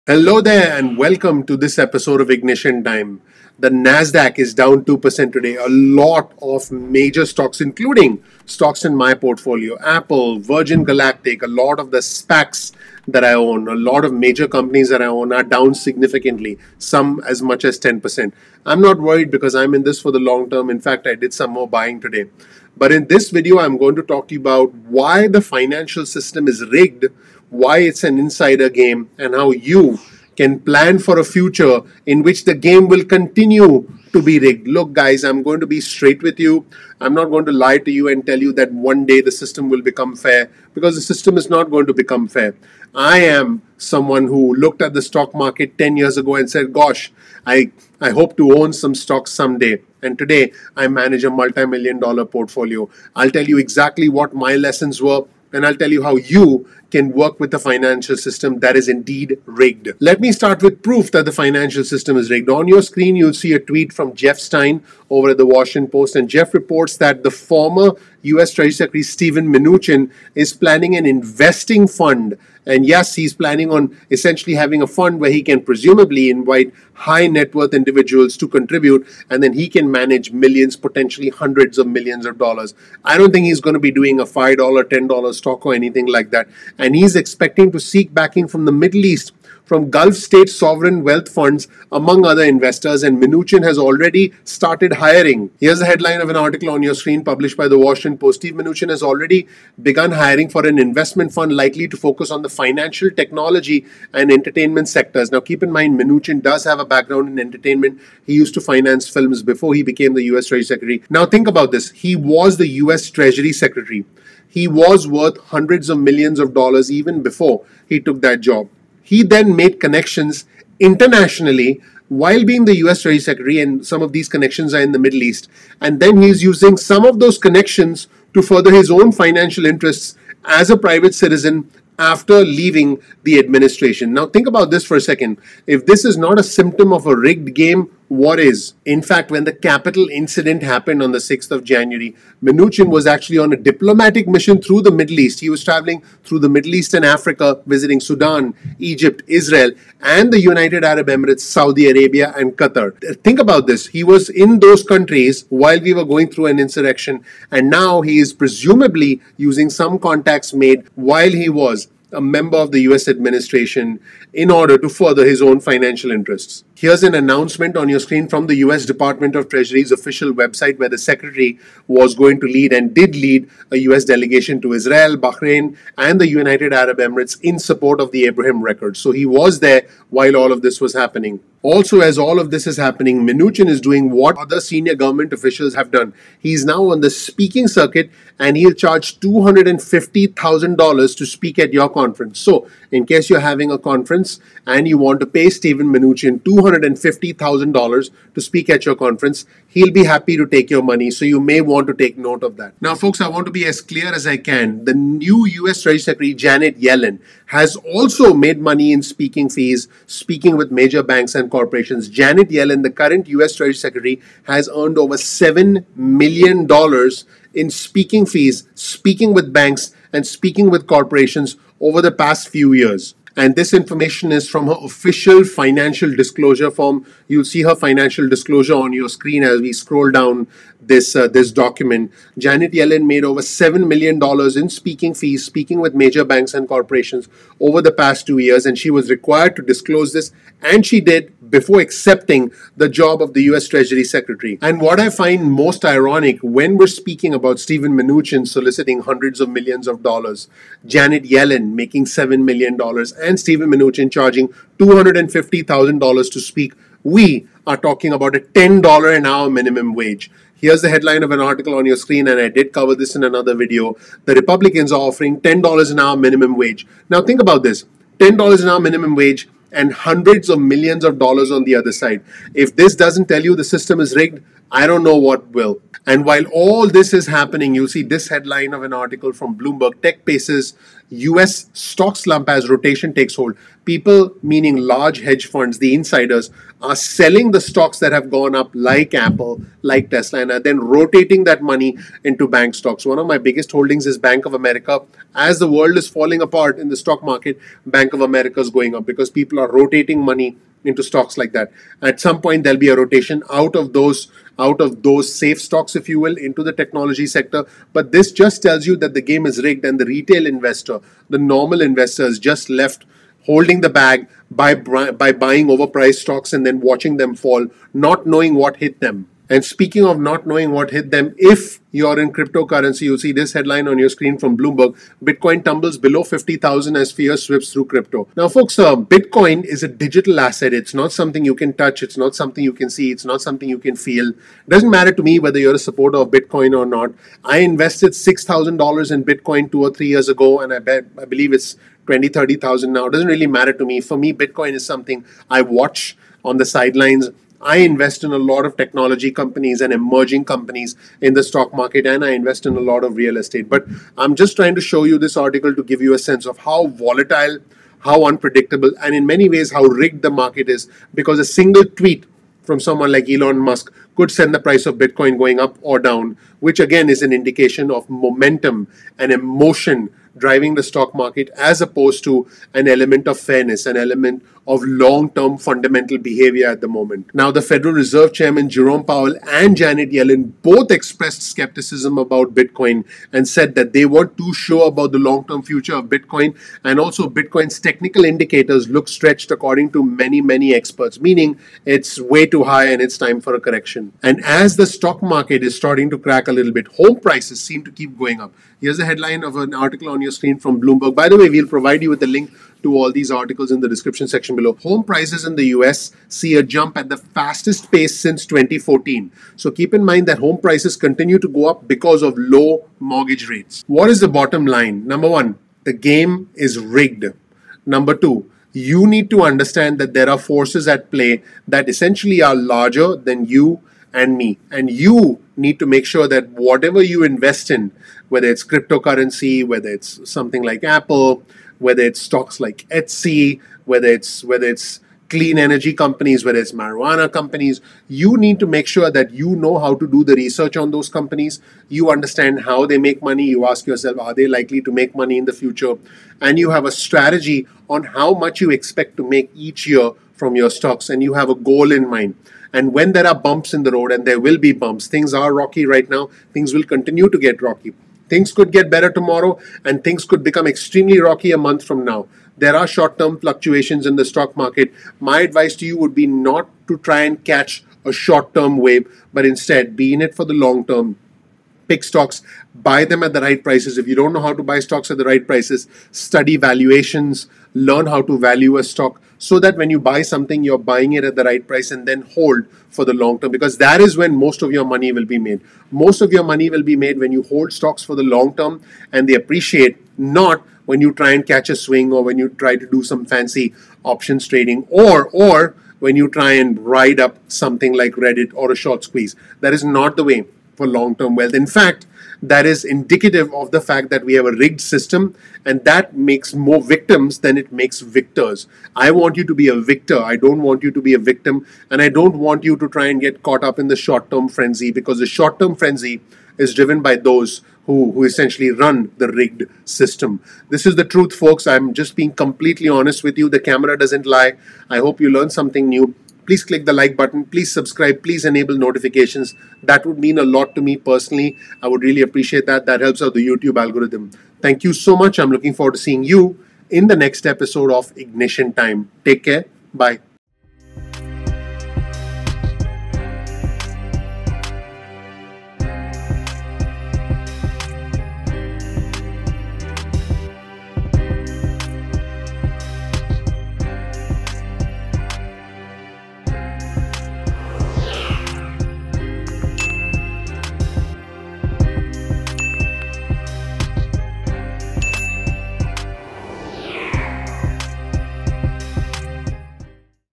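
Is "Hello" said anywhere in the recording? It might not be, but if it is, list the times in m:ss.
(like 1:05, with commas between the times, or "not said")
0:00.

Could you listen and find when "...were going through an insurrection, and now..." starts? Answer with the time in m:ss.
2:35.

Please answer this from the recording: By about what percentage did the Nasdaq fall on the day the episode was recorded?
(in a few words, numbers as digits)
2%.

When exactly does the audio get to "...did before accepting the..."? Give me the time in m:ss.
4:00.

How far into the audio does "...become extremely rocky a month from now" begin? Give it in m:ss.
7:40.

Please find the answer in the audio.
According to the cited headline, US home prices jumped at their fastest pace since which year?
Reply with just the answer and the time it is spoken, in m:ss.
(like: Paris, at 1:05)
2014, at 6:48.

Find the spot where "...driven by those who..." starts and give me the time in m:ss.
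8:36.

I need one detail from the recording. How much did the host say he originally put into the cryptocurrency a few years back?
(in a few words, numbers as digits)
$6,000.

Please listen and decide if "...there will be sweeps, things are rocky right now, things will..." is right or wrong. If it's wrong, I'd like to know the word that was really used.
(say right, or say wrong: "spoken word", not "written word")
wrong: "bumps", not "sweeps".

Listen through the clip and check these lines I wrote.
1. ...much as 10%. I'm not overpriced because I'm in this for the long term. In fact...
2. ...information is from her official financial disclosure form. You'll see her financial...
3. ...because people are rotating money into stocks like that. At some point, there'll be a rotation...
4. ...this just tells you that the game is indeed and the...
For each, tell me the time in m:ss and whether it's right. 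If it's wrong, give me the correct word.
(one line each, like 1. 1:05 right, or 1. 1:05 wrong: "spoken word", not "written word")
1. 0:17 wrong: "worried", not "overpriced"
2. 3:43 right
3. 4:59 right
4. 5:08 wrong: "rigged", not "indeed".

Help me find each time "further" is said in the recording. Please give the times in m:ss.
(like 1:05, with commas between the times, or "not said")
2:08, 2:44.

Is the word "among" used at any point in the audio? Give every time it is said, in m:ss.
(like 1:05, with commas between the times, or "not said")
1:31.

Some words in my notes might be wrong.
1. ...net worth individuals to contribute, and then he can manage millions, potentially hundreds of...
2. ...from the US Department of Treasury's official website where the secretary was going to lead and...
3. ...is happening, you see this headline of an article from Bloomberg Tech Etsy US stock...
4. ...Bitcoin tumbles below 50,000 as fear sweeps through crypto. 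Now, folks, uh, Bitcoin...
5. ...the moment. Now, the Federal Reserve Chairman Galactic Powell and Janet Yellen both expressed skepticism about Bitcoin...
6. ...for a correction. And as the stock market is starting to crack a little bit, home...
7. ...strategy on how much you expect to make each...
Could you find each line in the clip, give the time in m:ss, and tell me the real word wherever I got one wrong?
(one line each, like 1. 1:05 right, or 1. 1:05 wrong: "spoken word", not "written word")
1. 1:17 right
2. 2:48 right
3. 4:37 wrong: "Paces", not "Etsy"
4. 5:25 right
5. 6:16 wrong: "Jerome", not "Galactic"
6. 6:33 right
7. 7:26 right.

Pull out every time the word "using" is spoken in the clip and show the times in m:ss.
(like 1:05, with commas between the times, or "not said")
2:06, 2:39.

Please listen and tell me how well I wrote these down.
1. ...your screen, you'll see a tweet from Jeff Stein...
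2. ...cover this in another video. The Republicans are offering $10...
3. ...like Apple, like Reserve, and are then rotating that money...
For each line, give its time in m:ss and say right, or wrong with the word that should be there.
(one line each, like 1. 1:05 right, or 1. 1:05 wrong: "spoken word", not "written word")
1. 1:02 right
2. 4:22 right
3. 4:48 wrong: "Tesla", not "Reserve".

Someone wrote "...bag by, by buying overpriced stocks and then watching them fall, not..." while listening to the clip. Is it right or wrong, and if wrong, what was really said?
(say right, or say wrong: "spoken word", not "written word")
right.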